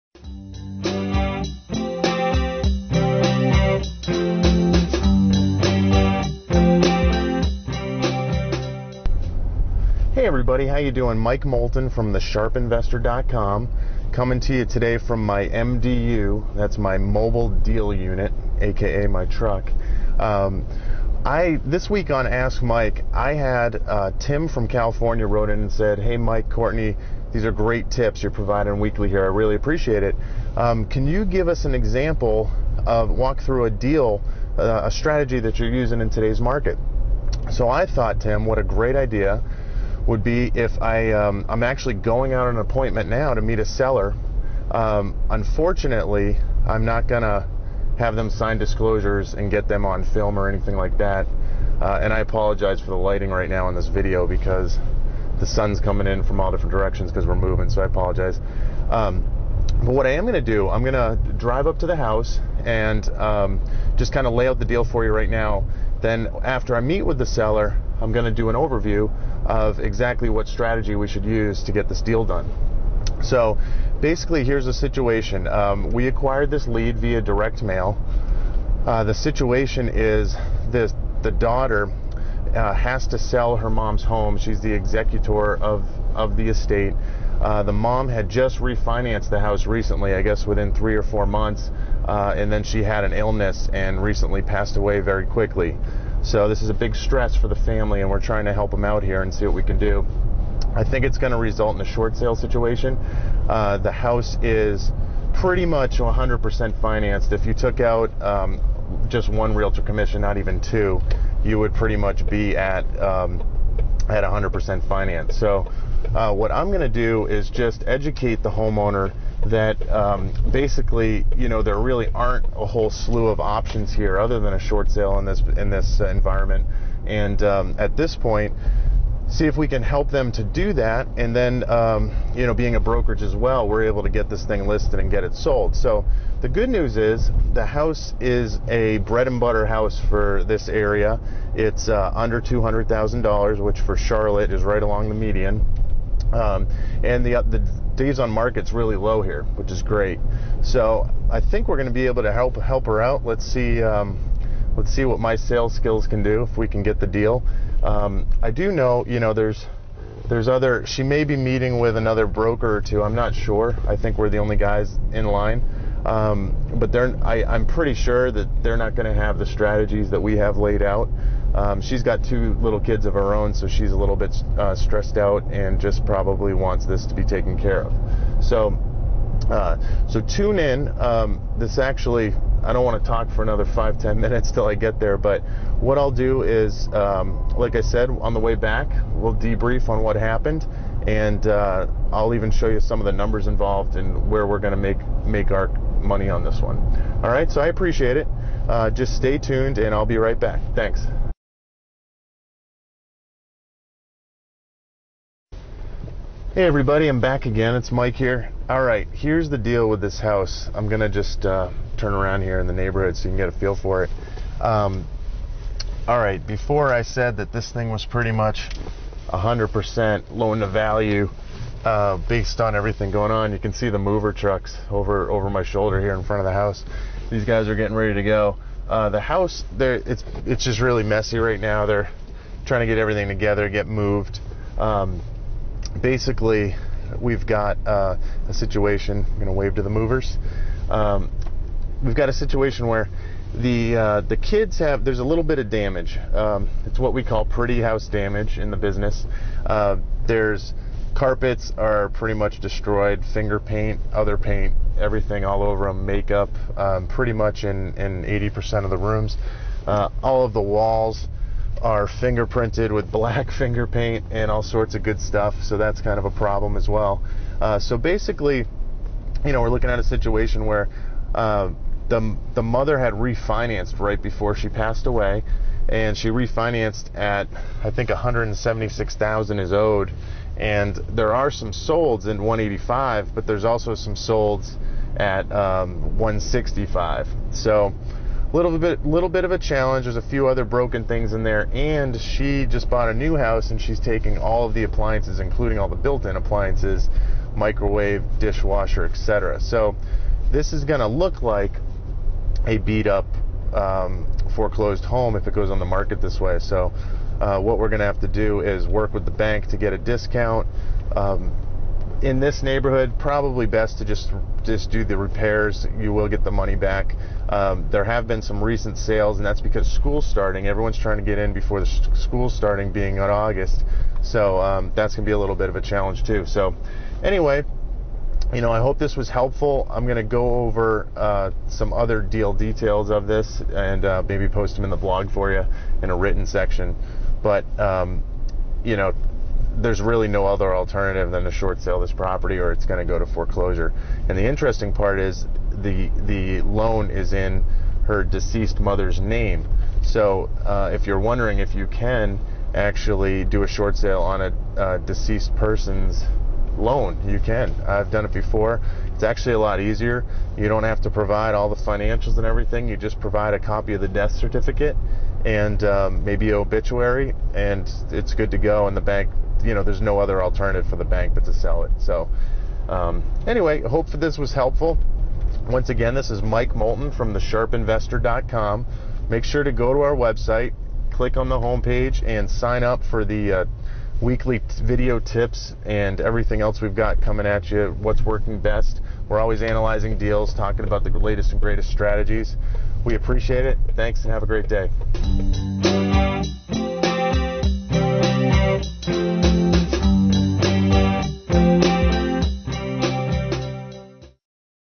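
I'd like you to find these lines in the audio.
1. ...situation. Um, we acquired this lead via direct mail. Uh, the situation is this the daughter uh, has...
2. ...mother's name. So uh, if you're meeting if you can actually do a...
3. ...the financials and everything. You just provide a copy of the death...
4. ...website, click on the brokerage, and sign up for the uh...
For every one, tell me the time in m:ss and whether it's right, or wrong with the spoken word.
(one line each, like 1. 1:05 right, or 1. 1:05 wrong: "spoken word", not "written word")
1. 1:14 right
2. 5:48 wrong: "wondering", not "meeting"
3. 6:01 right
4. 6:20 wrong: "homepage", not "brokerage".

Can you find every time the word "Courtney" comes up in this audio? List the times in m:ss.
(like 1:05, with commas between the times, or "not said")
0:26.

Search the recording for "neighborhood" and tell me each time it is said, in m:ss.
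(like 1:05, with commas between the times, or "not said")
3:32, 5:12.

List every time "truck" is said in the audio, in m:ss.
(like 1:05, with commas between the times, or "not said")
0:19, 3:44.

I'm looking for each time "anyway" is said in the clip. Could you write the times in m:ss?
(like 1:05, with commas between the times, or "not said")
5:27, 6:13.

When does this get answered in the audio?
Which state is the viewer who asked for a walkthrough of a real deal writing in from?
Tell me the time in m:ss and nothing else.
0:24.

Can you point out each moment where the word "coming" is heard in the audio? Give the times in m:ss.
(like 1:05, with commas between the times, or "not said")
0:14, 0:55, 6:27.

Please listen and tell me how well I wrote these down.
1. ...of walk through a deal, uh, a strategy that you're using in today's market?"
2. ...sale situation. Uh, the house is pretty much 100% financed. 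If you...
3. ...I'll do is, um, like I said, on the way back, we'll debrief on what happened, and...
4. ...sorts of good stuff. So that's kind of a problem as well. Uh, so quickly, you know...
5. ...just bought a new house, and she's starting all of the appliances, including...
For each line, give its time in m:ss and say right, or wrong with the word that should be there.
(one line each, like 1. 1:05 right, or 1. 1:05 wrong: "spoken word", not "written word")
1. 0:32 right
2. 1:42 right
3. 3:05 right
4. 4:24 wrong: "basically", not "quickly"
5. 4:52 wrong: "taking", not "starting".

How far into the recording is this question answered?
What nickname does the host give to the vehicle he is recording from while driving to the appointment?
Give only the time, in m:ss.
0:16.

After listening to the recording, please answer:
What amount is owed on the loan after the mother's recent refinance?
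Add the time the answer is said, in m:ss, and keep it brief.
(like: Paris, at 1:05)
176,000, at 4:38.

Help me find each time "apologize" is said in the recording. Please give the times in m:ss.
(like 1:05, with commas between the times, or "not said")
0:52, 0:57.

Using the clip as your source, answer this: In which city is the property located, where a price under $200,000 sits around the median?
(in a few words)
Charlotte.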